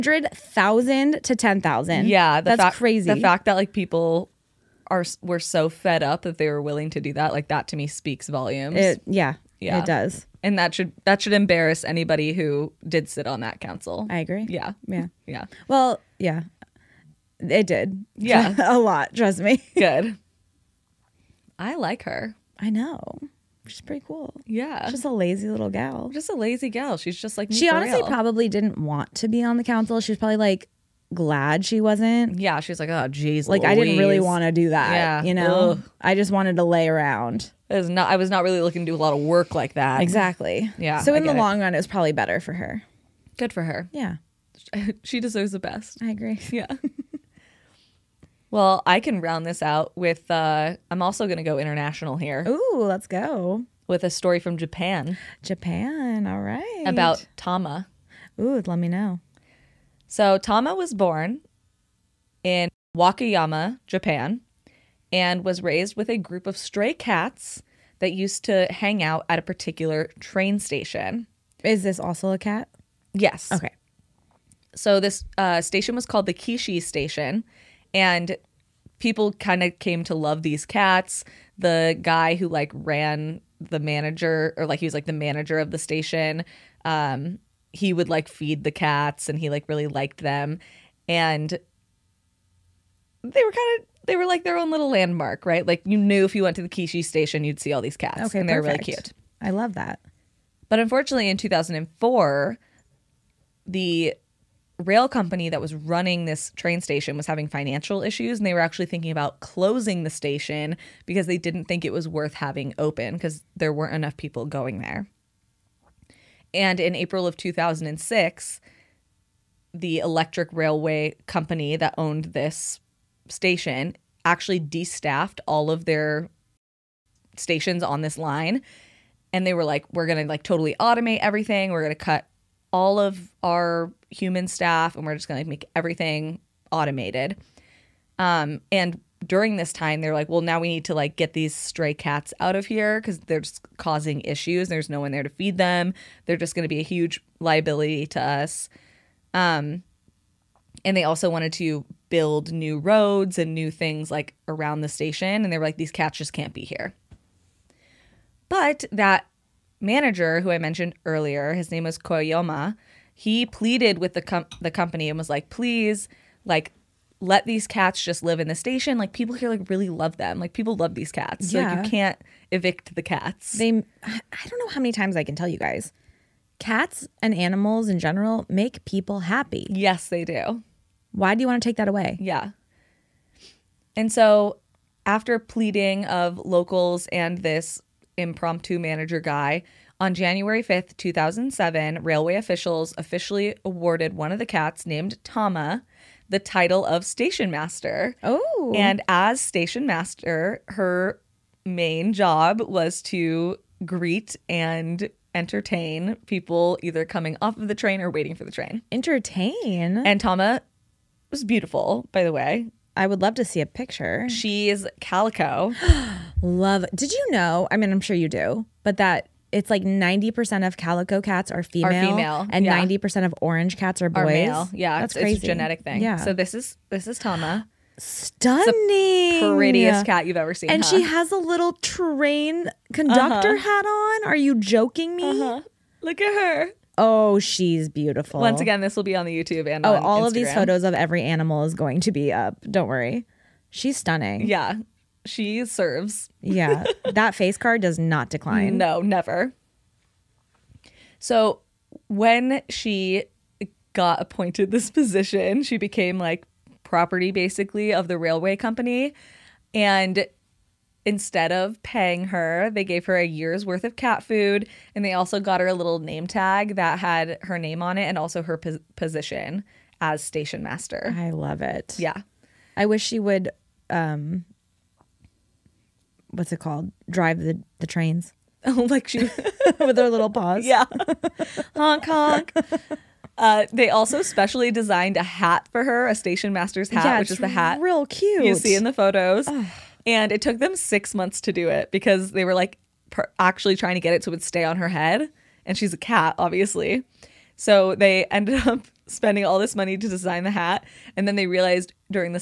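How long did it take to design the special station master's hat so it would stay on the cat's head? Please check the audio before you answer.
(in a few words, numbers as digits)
6 months.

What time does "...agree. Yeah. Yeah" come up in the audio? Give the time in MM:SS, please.
00:14.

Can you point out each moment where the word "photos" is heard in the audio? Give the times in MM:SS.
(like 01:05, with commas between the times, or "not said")
04:00, 04:48.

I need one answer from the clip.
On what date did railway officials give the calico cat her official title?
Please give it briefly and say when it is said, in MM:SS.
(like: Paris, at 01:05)
January 5th, 2007, at 03:10.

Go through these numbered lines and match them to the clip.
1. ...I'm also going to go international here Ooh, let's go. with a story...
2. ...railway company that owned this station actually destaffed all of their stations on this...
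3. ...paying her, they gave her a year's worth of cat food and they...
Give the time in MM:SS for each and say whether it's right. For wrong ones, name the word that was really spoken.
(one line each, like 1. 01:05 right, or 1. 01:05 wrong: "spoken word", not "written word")
1. 00:50 right
2. 02:00 right
3. 04:21 right.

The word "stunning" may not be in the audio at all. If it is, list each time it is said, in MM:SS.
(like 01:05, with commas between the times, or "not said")
03:47, 04:03.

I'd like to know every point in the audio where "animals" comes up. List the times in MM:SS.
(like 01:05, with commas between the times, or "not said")
02:57, 04:01.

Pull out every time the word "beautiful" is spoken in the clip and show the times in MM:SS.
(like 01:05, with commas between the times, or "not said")
03:31, 03:57.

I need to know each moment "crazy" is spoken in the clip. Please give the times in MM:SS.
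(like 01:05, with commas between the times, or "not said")
00:02, 03:45.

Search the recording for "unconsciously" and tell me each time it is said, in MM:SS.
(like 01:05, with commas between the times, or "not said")
not said.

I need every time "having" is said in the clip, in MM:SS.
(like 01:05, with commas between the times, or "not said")
01:47, 01:52.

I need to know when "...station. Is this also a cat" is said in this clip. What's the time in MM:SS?
01:10.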